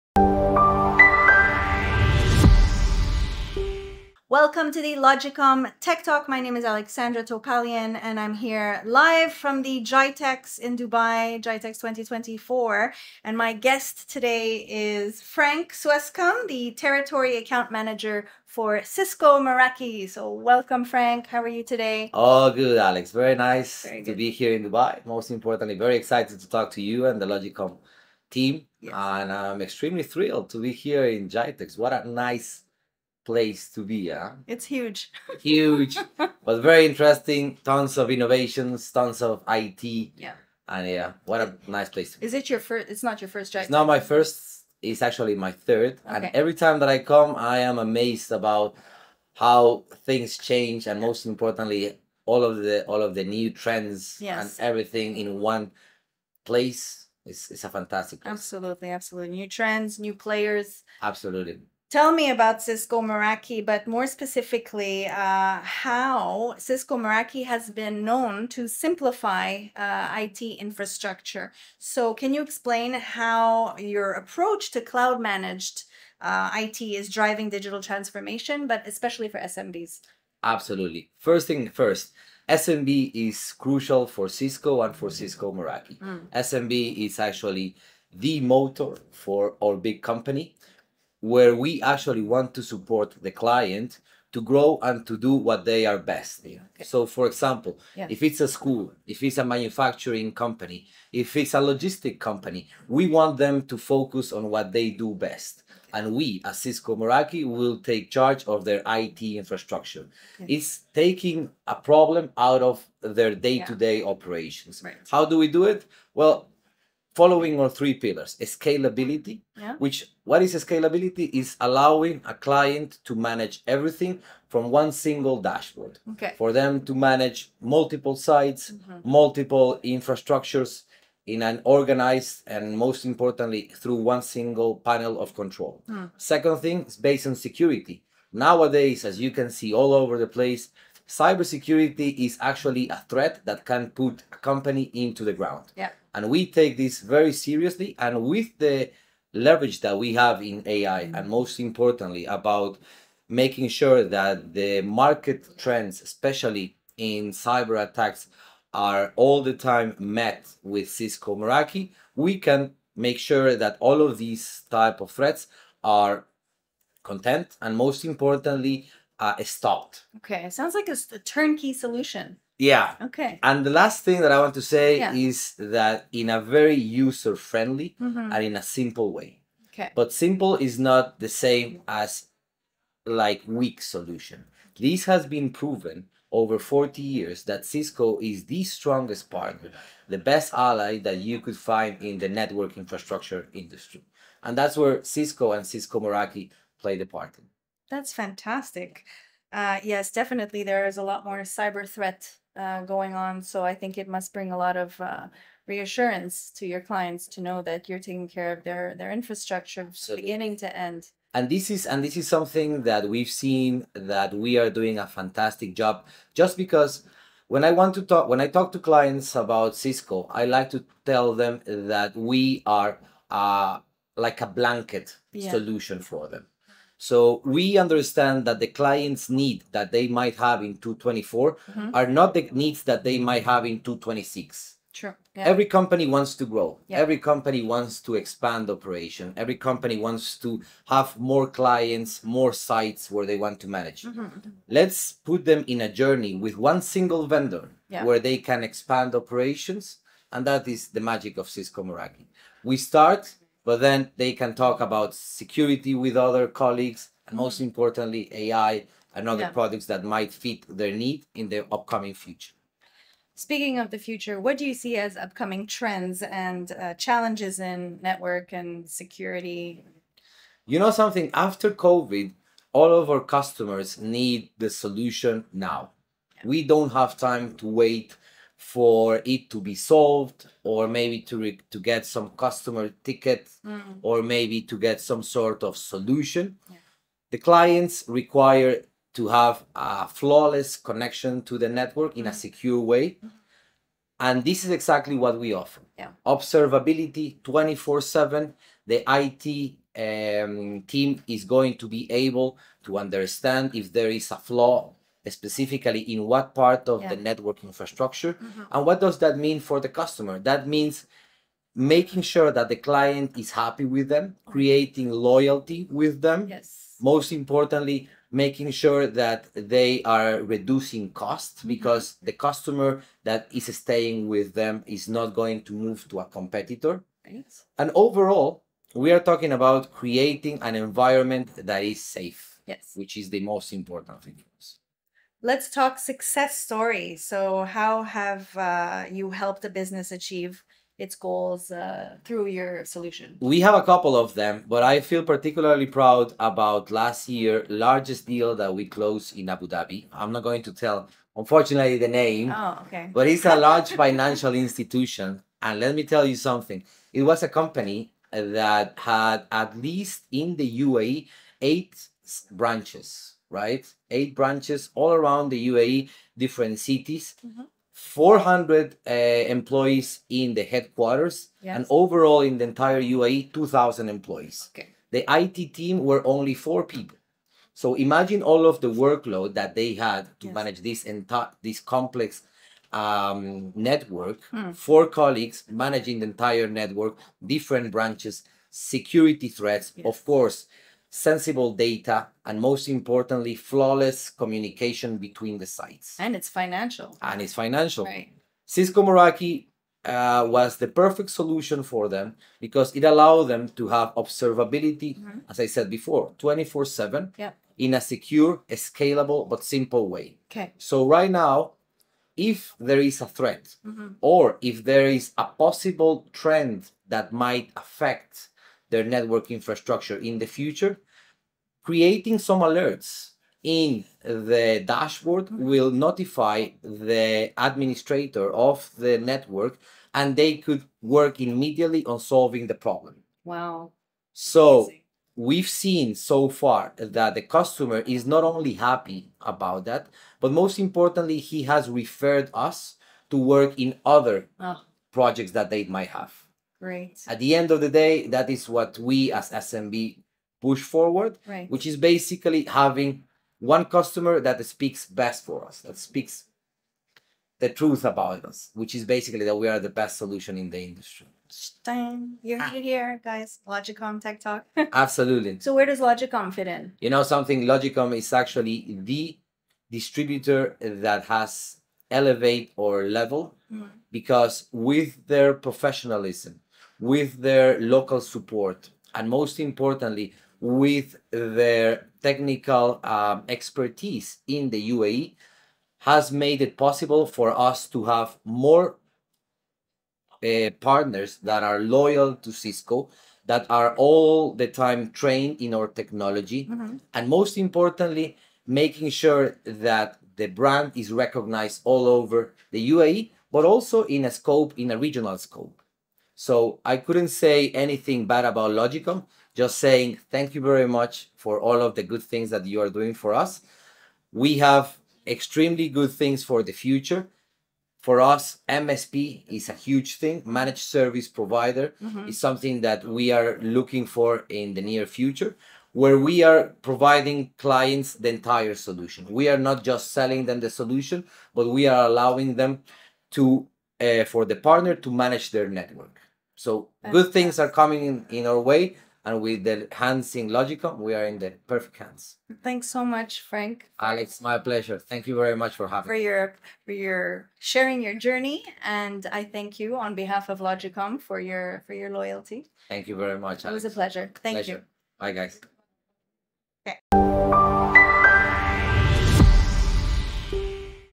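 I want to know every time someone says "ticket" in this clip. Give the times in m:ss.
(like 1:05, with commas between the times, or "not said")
4:43.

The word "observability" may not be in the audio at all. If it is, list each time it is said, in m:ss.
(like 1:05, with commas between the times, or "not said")
4:56, 6:44.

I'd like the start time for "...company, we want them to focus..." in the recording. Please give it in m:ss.
1:42.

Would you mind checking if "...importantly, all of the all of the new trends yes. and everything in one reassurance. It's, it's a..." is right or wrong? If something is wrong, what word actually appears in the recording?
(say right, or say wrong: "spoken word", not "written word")
wrong: "place", not "reassurance".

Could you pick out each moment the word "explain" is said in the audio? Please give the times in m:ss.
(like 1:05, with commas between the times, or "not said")
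1:12.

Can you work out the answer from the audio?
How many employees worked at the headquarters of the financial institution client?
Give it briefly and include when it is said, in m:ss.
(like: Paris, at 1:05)
400, at 6:08.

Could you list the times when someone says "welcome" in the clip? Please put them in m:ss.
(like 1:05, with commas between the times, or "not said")
0:04, 0:20.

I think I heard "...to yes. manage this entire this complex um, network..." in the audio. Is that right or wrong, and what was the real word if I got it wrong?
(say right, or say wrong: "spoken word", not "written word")
right.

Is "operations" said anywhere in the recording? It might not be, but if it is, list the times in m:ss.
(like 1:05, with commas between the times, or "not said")
1:54, 3:58, 4:09.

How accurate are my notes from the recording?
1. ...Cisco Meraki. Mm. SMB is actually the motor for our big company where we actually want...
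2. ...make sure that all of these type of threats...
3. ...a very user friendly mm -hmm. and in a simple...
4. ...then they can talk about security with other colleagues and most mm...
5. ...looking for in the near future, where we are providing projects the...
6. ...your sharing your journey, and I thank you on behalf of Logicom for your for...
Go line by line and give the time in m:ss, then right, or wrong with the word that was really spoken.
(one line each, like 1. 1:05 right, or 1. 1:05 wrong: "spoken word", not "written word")
1. 1:25 right
2. 2:42 right
3. 2:56 right
4. 4:13 right
5. 8:43 wrong: "clients", not "projects"
6. 9:06 right.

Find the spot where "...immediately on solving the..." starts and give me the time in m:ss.
7:11.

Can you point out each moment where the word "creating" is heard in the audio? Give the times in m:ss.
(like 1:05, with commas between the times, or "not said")
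5:14, 5:29, 7:01.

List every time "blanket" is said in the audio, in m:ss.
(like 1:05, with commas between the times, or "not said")
3:44.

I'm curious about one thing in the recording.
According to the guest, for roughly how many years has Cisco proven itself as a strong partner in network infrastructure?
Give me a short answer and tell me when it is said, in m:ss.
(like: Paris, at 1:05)
40 years, at 3:06.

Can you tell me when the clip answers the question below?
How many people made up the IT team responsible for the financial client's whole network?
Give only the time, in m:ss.
6:16.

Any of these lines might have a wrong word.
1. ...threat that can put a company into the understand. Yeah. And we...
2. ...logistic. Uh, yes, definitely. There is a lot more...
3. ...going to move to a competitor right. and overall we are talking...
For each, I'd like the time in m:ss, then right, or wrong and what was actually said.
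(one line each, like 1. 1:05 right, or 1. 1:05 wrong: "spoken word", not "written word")
1. 2:23 wrong: "ground", not "understand"
2. 3:18 wrong: "fantastic", not "logistic"
3. 5:25 right.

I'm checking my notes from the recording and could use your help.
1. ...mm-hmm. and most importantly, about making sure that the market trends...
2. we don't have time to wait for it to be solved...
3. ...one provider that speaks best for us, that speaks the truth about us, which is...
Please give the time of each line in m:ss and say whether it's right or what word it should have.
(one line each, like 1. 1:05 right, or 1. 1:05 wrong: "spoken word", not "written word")
1. 2:31 right
2. 4:36 right
3. 7:33 wrong: "customer", not "provider".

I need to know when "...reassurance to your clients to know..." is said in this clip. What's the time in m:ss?
3:25.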